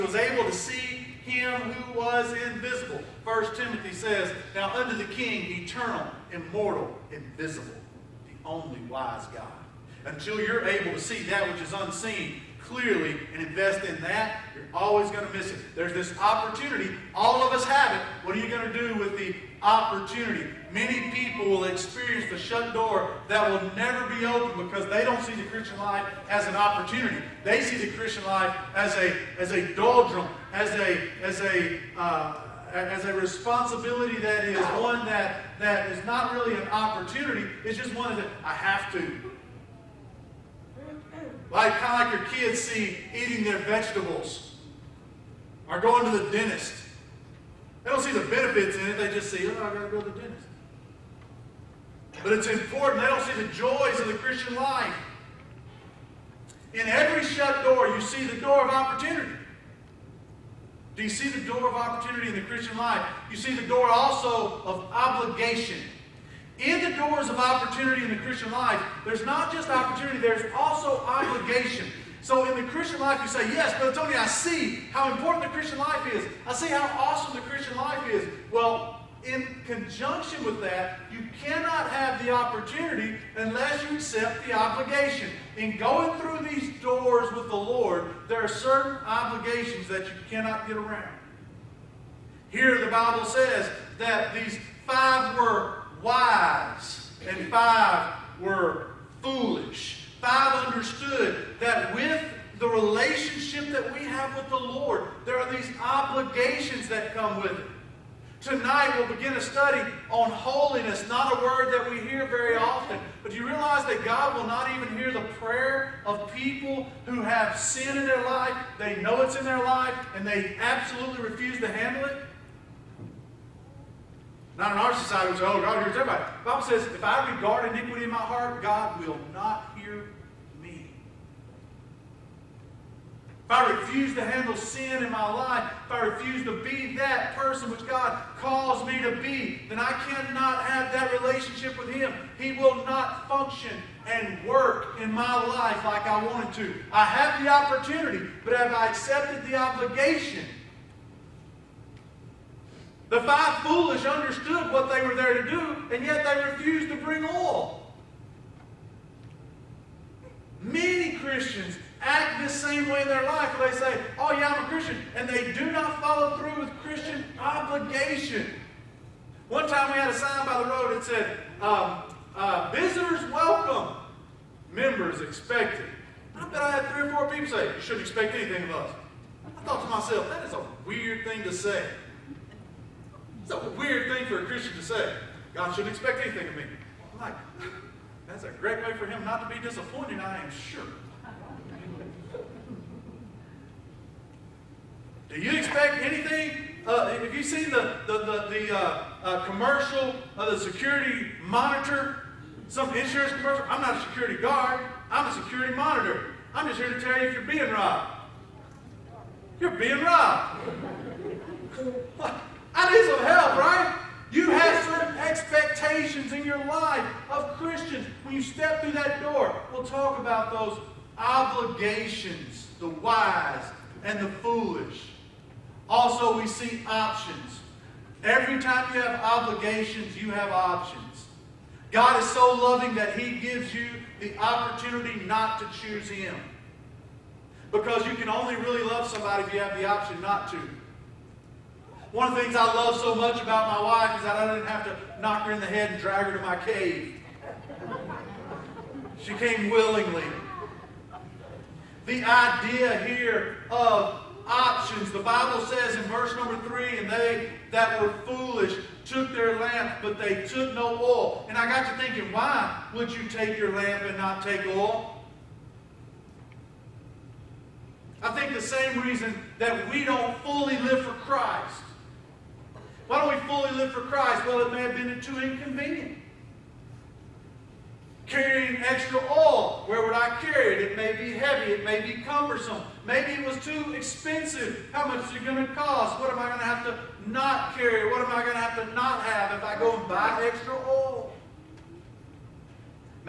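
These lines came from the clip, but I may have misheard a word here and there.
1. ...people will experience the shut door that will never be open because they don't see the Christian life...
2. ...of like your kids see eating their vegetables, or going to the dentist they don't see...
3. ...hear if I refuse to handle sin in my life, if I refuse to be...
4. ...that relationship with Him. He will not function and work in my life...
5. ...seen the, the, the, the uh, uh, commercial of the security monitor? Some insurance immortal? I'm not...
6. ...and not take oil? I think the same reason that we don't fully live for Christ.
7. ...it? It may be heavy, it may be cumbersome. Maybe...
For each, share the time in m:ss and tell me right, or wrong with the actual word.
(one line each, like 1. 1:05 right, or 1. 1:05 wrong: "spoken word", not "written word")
1. 0:21 right
2. 0:42 right
3. 2:09 right
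4. 2:20 right
5. 3:17 wrong: "commercial", not "immortal"
6. 4:24 right
7. 4:40 right.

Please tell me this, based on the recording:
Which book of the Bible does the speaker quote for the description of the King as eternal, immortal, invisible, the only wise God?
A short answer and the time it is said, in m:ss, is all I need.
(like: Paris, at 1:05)
First Timothy, at 0:03.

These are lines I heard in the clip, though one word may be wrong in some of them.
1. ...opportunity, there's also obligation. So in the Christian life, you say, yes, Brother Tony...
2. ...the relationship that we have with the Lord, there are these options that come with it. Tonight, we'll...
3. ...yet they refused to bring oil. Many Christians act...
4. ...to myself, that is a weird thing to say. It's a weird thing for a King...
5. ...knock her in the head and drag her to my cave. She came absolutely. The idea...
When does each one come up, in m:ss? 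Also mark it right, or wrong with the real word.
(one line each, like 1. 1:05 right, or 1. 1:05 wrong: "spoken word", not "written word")
1. 1:09 right
2. 1:42 wrong: "obligations", not "options"
3. 2:36 right
4. 2:59 wrong: "Christian", not "King"
5. 4:05 wrong: "willingly", not "absolutely".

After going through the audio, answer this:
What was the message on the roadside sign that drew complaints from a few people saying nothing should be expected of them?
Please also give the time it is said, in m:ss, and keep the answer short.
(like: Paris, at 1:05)
Visitors welcome, members expected, at 2:52.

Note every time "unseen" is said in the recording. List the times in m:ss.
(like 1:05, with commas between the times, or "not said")
0:11.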